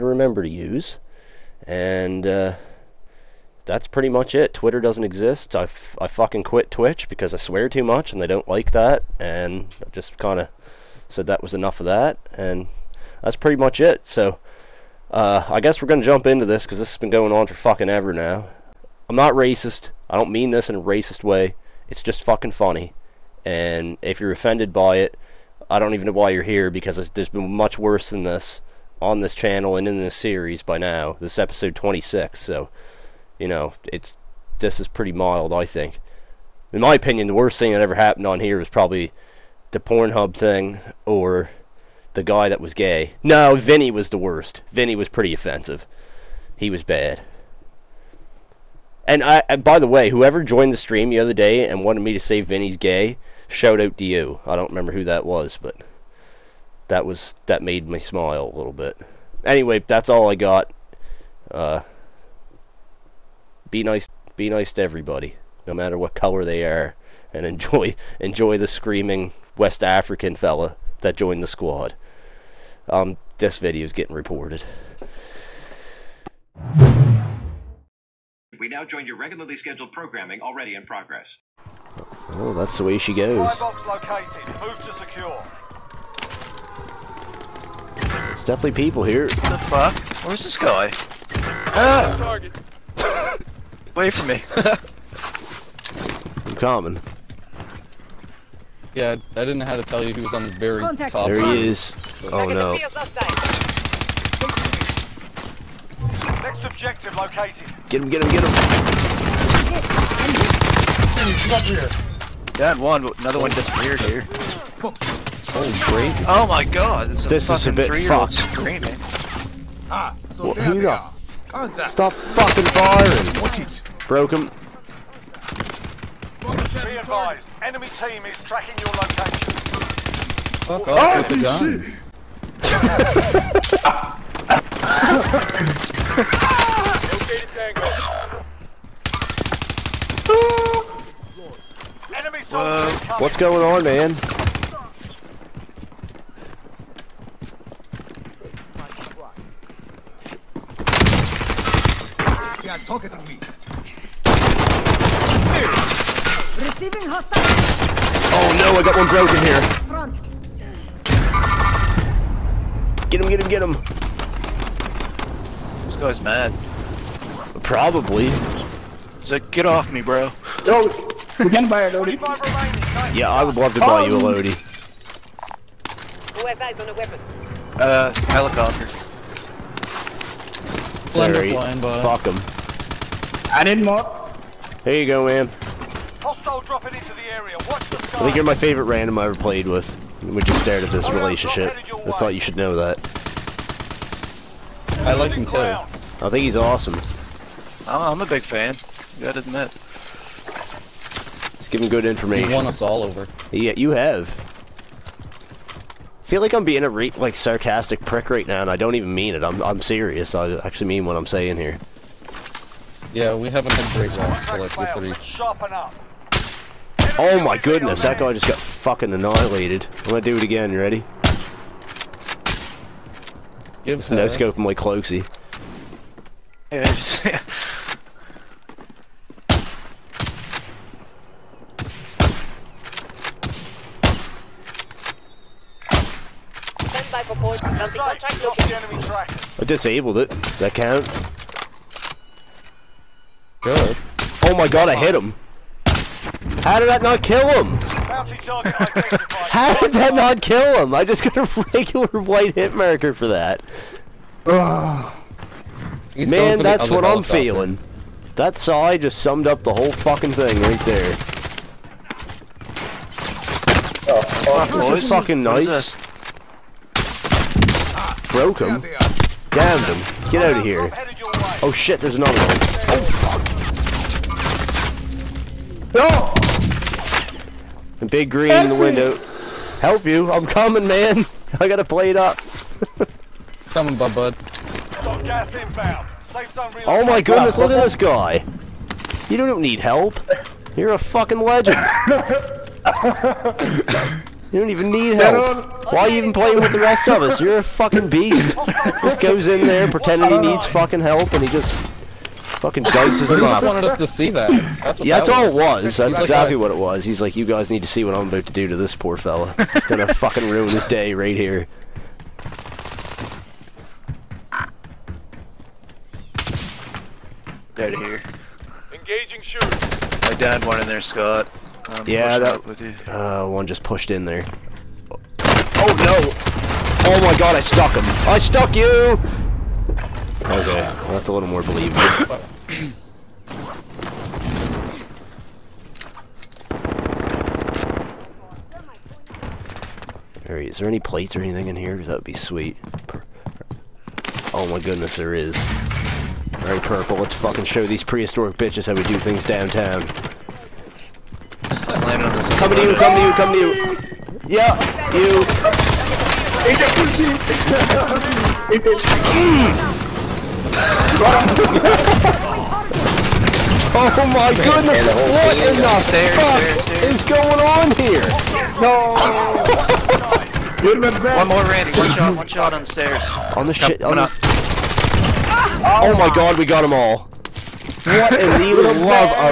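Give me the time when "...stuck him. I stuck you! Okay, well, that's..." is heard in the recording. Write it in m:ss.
5:27.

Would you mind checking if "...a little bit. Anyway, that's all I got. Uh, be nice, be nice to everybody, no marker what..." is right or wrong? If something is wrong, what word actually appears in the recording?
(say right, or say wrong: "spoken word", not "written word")
wrong: "matter", not "marker".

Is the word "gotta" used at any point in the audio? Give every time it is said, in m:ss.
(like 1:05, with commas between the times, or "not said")
3:19, 4:41.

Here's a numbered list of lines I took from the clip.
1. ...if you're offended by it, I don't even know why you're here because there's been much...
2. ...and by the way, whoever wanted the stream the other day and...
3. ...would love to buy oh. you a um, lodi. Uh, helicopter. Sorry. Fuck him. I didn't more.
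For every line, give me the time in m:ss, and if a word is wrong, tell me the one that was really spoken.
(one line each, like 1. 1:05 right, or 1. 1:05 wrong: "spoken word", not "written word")
1. 0:23 right
2. 0:49 wrong: "joined", not "wanted"
3. 2:53 right.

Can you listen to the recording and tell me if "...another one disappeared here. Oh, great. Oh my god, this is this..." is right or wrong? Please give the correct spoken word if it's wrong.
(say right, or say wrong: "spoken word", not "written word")
right.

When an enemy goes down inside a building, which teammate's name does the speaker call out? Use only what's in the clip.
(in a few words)
Scott.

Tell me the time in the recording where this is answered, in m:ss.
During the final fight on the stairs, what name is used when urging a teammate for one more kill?
6:11.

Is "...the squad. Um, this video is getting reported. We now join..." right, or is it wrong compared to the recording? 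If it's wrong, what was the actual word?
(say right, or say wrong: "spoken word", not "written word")
right.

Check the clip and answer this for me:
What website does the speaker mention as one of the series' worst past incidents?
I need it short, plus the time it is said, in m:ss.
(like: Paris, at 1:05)
Pornhub, at 0:39.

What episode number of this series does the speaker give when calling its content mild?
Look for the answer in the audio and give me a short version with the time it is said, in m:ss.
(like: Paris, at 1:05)
26, at 0:31.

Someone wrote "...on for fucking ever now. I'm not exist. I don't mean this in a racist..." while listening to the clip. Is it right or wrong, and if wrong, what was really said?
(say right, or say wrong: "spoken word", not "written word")
wrong: "racist", not "exist".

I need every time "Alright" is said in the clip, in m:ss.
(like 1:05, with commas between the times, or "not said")
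5:40, 5:46.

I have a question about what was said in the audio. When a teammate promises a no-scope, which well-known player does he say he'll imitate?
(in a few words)
Cloakzy.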